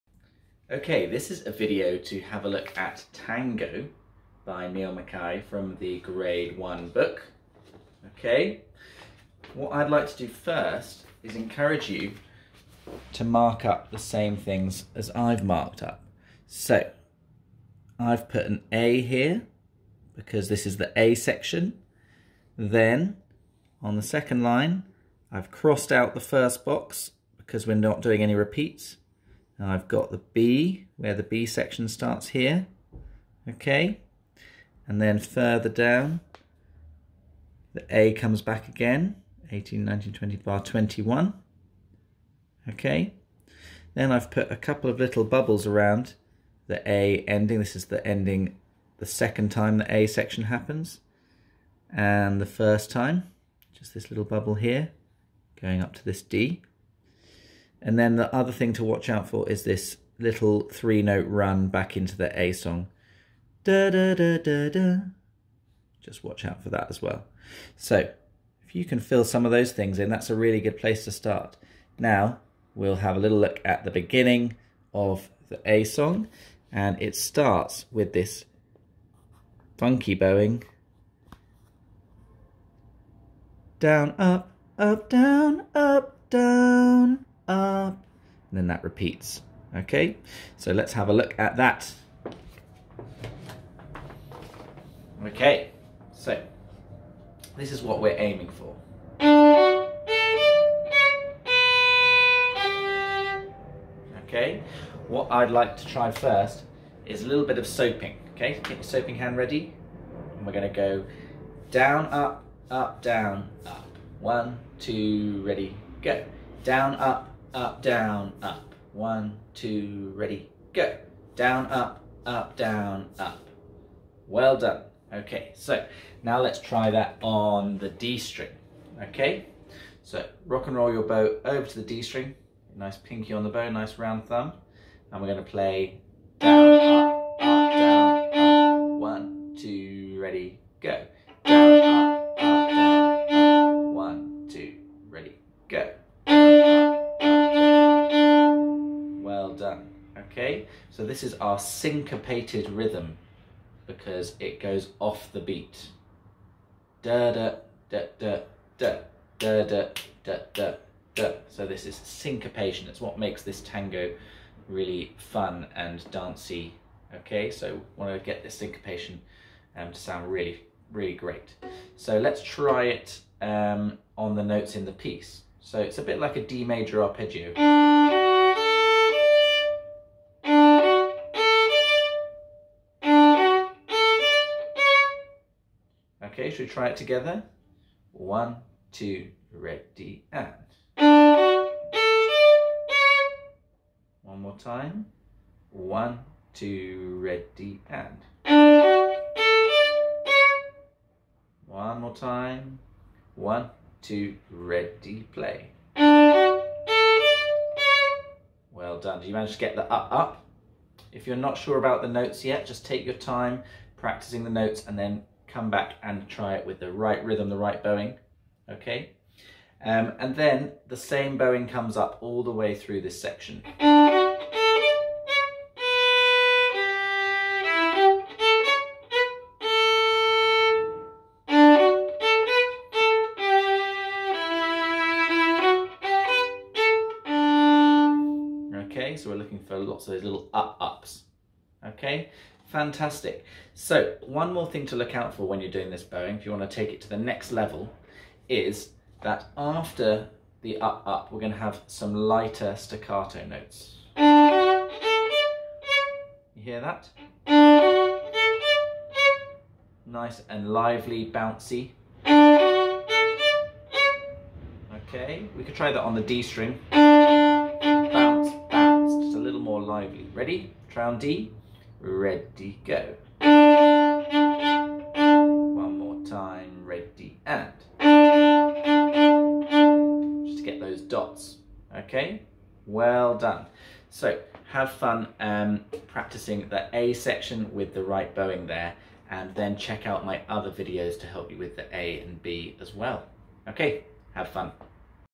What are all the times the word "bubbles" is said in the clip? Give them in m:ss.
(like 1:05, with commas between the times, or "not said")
0:45, 0:54.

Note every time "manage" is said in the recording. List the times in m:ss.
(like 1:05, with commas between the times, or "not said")
3:29.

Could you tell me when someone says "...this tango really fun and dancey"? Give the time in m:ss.
2:43.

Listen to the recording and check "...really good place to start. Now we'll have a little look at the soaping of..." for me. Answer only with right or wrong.
wrong.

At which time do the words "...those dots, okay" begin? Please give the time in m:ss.
4:40.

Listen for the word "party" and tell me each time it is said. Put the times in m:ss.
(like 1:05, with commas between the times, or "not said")
not said.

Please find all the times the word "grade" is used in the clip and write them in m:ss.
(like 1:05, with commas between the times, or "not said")
0:05.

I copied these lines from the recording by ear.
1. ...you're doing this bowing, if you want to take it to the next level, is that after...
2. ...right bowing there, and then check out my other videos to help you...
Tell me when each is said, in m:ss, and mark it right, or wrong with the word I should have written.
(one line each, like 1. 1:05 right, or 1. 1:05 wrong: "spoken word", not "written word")
1. 4:05 right
2. 4:48 right.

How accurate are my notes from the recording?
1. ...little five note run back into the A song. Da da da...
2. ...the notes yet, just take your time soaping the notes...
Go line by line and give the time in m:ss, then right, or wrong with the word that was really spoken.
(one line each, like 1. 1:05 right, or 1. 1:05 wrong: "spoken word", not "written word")
1. 1:00 wrong: "three", not "five"
2. 3:32 wrong: "practicing", not "soaping".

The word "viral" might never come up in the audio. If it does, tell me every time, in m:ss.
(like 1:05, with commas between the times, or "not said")
not said.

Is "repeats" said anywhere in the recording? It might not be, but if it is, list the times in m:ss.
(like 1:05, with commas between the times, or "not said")
0:28, 1:28.